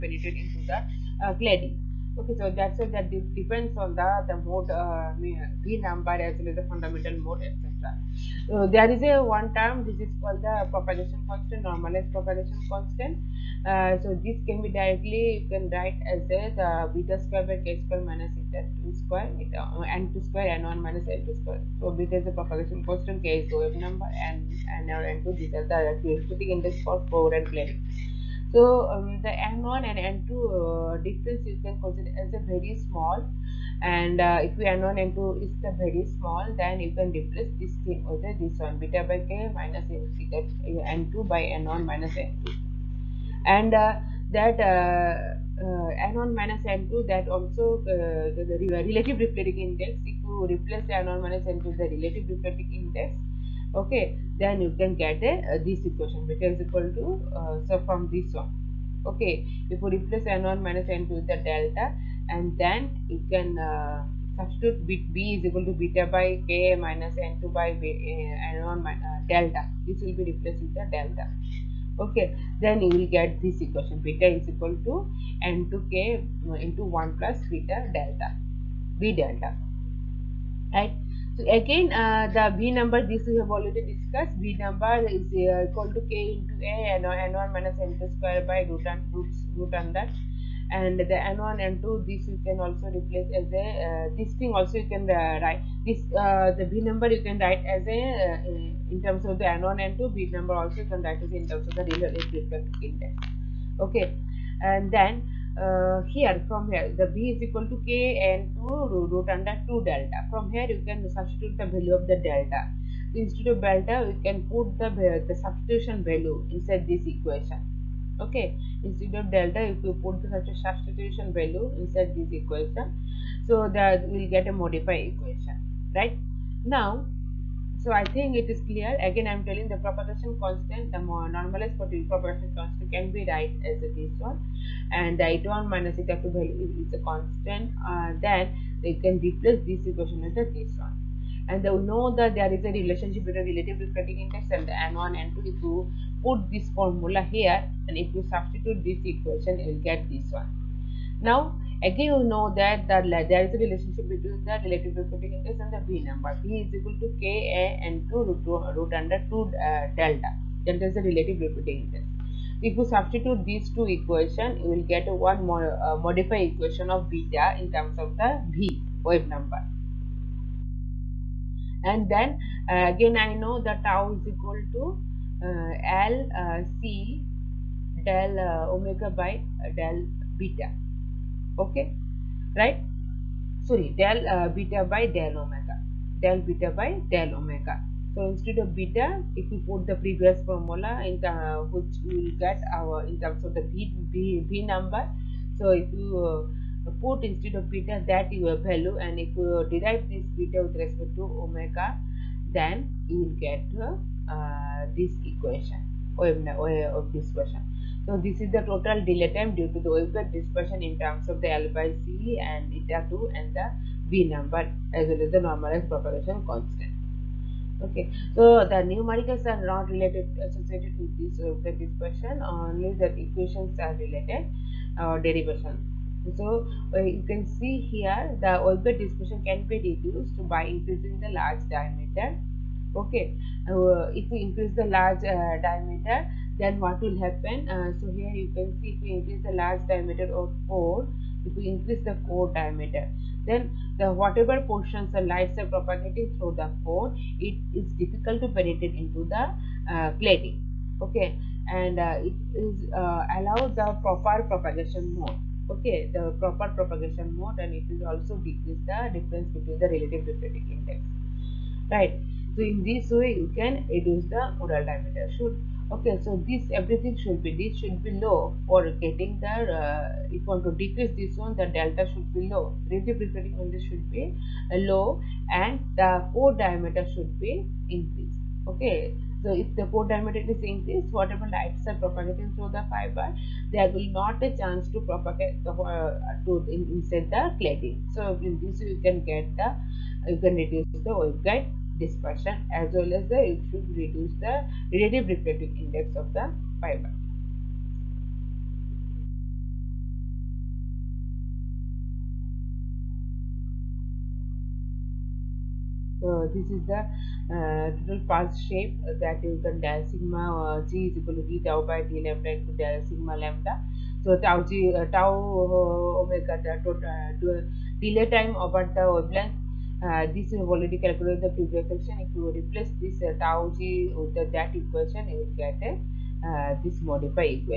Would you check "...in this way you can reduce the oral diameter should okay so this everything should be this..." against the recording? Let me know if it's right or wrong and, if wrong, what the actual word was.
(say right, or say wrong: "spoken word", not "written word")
right.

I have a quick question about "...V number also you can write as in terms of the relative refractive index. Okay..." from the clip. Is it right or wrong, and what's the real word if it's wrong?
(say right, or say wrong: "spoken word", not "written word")
right.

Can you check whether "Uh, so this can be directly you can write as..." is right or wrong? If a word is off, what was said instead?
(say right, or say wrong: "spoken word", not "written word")
right.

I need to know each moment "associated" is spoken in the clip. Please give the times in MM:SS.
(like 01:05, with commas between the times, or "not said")
03:40.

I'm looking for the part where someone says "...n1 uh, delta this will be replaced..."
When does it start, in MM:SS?
01:08.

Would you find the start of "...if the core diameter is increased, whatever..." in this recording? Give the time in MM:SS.
04:39.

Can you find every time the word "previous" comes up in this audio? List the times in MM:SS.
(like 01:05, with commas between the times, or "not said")
03:09, 05:21.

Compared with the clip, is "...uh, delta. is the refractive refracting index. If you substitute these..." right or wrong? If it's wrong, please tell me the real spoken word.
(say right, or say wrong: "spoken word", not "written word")
wrong: "relative", not "refractive".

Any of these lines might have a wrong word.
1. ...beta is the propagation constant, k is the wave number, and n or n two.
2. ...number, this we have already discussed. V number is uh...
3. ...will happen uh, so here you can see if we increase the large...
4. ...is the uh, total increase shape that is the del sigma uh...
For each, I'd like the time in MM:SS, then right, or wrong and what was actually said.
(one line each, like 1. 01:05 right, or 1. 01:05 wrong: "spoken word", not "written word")
1. 00:21 right
2. 01:22 right
3. 03:56 right
4. 05:06 wrong: "pulse", not "increase".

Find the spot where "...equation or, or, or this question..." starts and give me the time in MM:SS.
03:25.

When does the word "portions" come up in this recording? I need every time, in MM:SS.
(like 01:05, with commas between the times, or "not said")
04:04.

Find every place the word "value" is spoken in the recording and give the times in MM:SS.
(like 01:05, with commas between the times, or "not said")
01:51, 01:56, 02:01, 02:16, 03:18.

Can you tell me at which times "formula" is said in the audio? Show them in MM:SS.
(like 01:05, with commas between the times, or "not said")
02:26, 03:10.